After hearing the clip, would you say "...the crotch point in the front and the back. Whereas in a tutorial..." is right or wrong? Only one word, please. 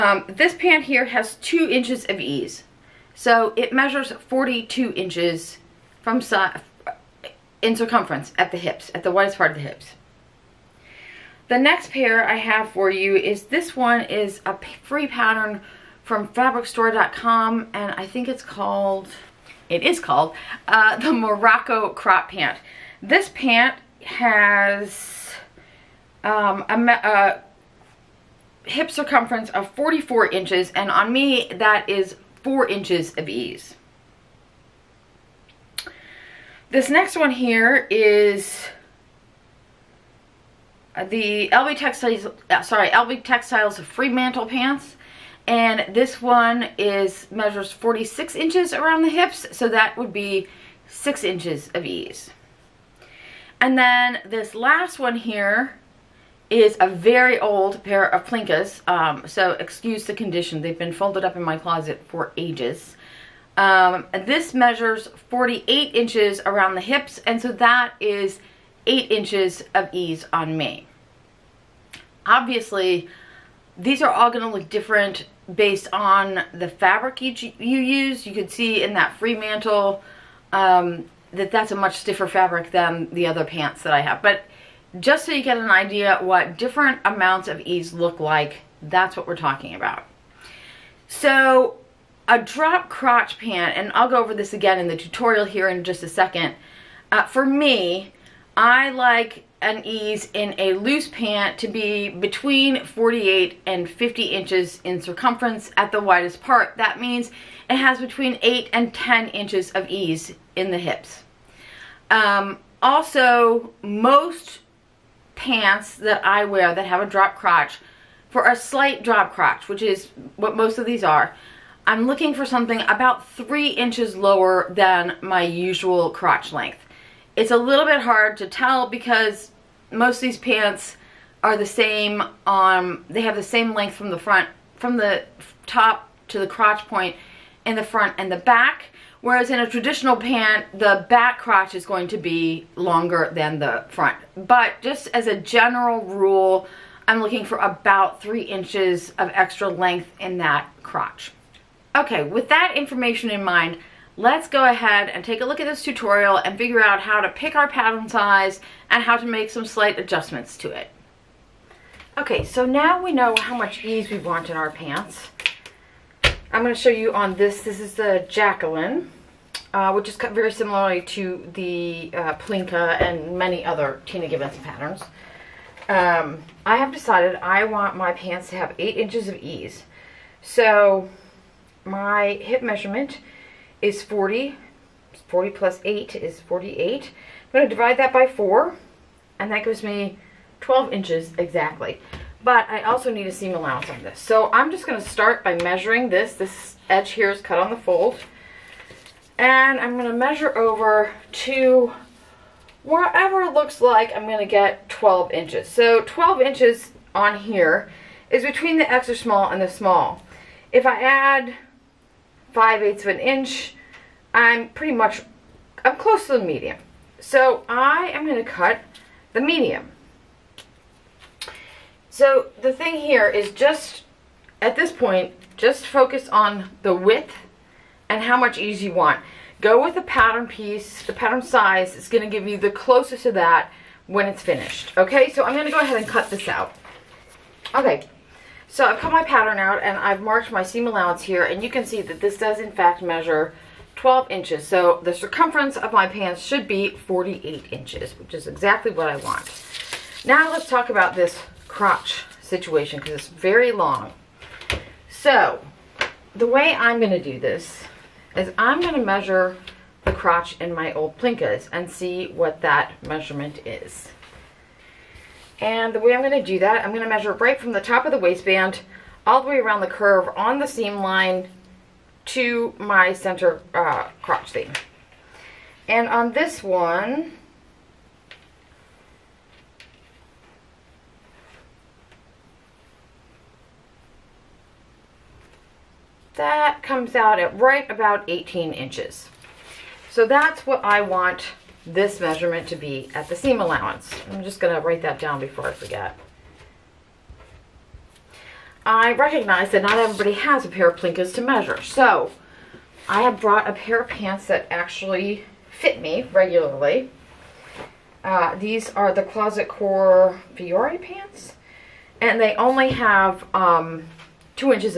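wrong.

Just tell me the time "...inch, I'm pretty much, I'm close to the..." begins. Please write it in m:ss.
3:33.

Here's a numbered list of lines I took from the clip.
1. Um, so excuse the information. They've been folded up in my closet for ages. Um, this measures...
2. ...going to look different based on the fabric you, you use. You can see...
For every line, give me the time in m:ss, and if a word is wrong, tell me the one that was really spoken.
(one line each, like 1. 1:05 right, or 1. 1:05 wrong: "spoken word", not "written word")
1. 0:58 wrong: "condition", not "information"
2. 1:14 right.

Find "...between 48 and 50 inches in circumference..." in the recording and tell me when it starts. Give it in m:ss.
1:42.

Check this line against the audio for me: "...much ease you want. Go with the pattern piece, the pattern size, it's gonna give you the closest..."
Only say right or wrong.
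right.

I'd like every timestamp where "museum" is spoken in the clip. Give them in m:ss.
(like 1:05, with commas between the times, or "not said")
not said.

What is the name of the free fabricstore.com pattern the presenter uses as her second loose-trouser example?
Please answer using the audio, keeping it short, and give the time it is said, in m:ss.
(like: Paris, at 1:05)
Morocco crop pant, at 0:20.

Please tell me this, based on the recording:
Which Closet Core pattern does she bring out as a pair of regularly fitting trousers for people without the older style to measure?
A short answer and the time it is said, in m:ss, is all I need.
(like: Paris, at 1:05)
Fiore pants, at 5:10.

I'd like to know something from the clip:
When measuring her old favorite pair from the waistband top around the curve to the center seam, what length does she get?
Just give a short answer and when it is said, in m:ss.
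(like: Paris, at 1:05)
18 inches, at 4:48.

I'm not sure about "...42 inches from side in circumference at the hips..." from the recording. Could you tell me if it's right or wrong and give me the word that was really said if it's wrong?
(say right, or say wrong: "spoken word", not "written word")
right.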